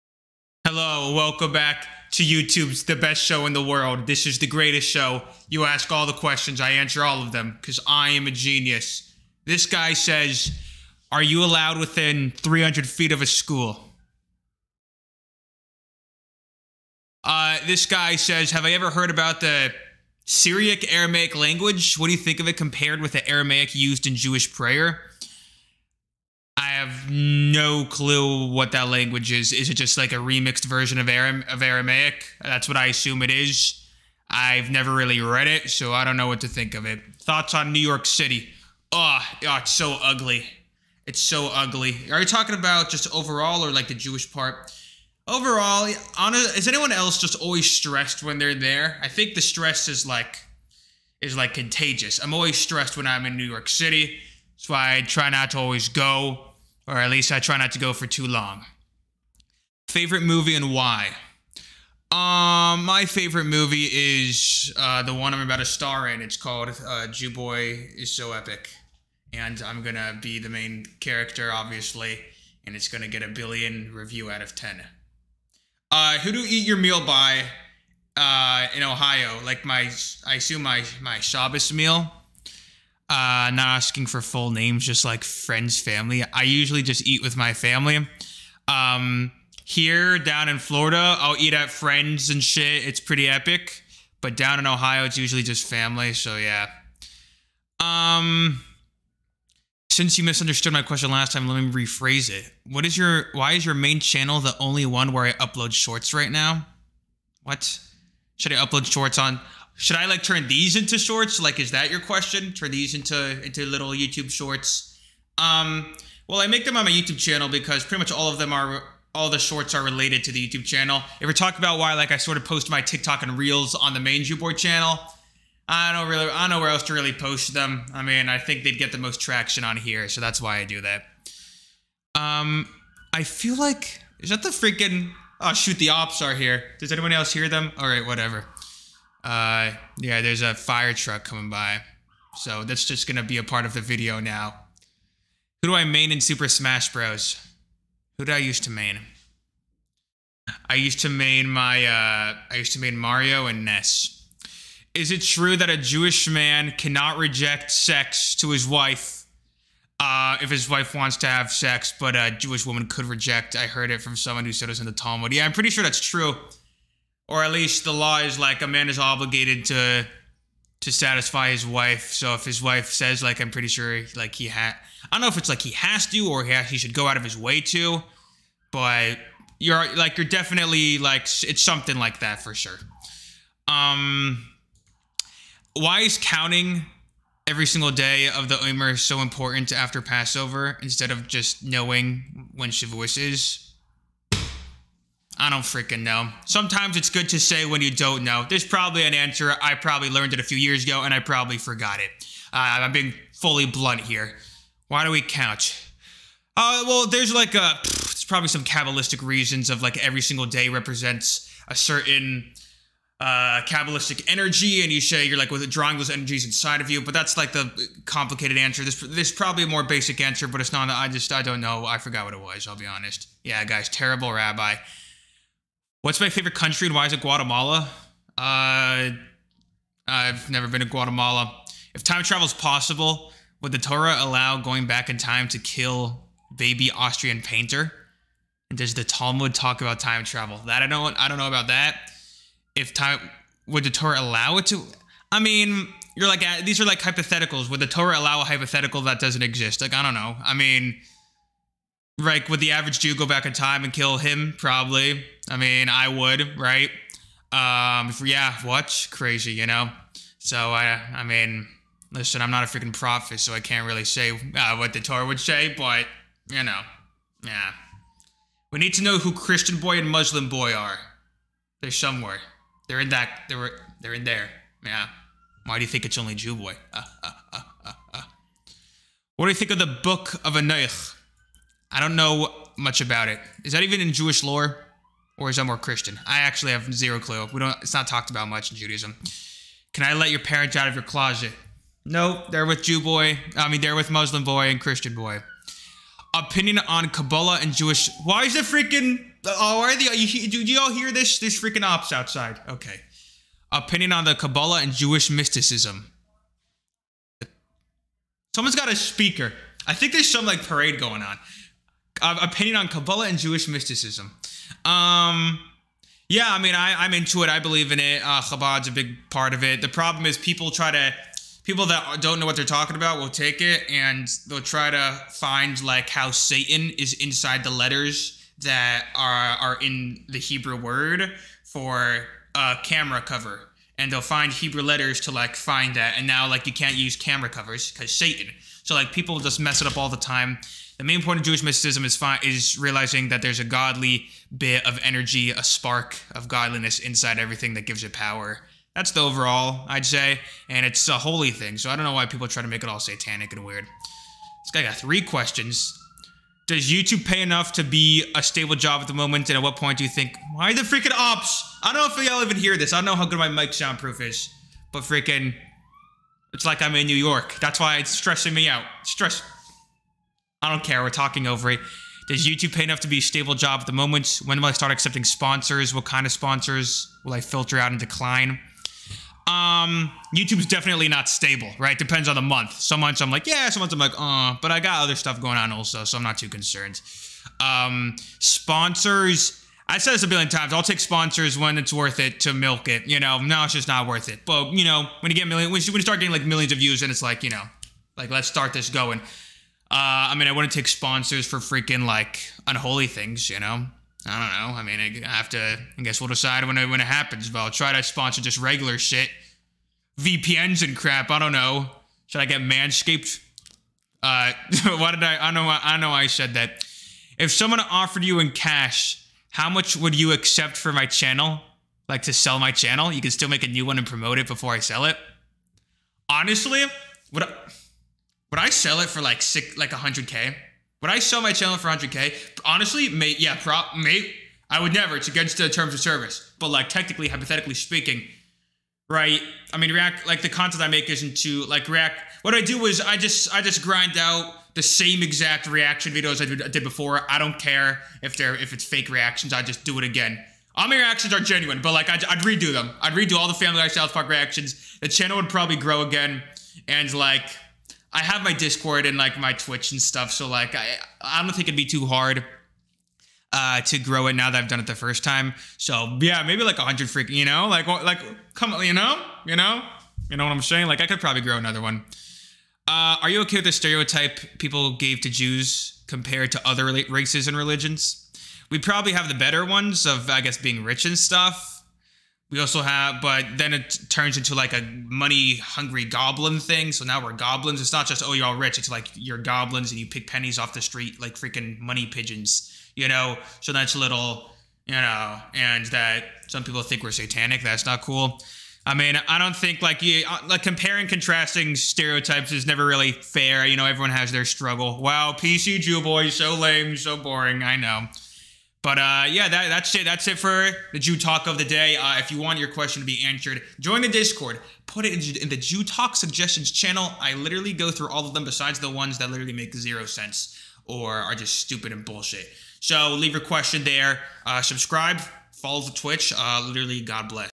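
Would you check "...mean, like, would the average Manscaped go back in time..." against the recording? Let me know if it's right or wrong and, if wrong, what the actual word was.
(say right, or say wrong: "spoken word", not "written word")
wrong: "Jew", not "Manscaped".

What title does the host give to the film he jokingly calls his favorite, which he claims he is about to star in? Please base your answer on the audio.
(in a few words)
Jew Boy is so epic.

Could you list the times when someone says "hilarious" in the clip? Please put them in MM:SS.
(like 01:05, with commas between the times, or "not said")
not said.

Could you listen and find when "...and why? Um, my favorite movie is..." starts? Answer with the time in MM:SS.
01:00.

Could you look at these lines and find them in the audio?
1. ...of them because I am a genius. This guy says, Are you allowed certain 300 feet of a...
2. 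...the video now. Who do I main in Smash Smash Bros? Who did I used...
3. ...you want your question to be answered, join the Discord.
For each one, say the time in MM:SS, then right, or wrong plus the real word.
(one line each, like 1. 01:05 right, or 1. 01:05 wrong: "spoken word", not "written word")
1. 00:07 wrong: "within", not "certain"
2. 02:23 wrong: "Super", not "Smash"
3. 08:32 right.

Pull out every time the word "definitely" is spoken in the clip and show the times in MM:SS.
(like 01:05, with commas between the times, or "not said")
03:00, 06:20.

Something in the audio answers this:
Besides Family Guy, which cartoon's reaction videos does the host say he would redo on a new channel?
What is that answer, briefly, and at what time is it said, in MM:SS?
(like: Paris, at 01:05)
South Park, at 07:33.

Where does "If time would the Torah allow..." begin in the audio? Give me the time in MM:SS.
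04:02.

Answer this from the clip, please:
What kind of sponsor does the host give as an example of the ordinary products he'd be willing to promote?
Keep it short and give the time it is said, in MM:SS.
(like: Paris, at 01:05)
VPNs, at 06:50.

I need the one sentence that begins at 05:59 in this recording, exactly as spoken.
And at what point do you think, why the freaking ops?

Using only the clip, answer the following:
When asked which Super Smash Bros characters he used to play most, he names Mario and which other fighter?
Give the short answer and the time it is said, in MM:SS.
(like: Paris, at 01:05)
Ness, at 02:33.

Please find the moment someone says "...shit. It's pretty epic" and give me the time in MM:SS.
01:32.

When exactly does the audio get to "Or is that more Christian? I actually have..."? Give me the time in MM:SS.
04:45.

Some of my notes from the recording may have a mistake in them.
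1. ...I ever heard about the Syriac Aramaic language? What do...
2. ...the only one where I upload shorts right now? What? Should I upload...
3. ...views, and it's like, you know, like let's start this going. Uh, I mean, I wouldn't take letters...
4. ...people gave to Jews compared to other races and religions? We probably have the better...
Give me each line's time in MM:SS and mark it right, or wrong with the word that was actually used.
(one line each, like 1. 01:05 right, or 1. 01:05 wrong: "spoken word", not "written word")
1. 00:18 right
2. 01:44 right
3. 06:36 wrong: "sponsors", not "letters"
4. 07:54 right.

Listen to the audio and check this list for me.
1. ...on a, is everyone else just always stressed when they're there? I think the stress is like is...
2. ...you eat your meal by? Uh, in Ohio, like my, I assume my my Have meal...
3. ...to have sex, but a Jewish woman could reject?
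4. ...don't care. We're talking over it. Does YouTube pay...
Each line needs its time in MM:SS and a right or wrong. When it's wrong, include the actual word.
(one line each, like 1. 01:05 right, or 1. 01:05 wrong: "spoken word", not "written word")
1. 00:46 wrong: "anyone", not "everyone"
2. 01:16 wrong: "Shabbos", not "Have"
3. 02:41 right
4. 06:10 right.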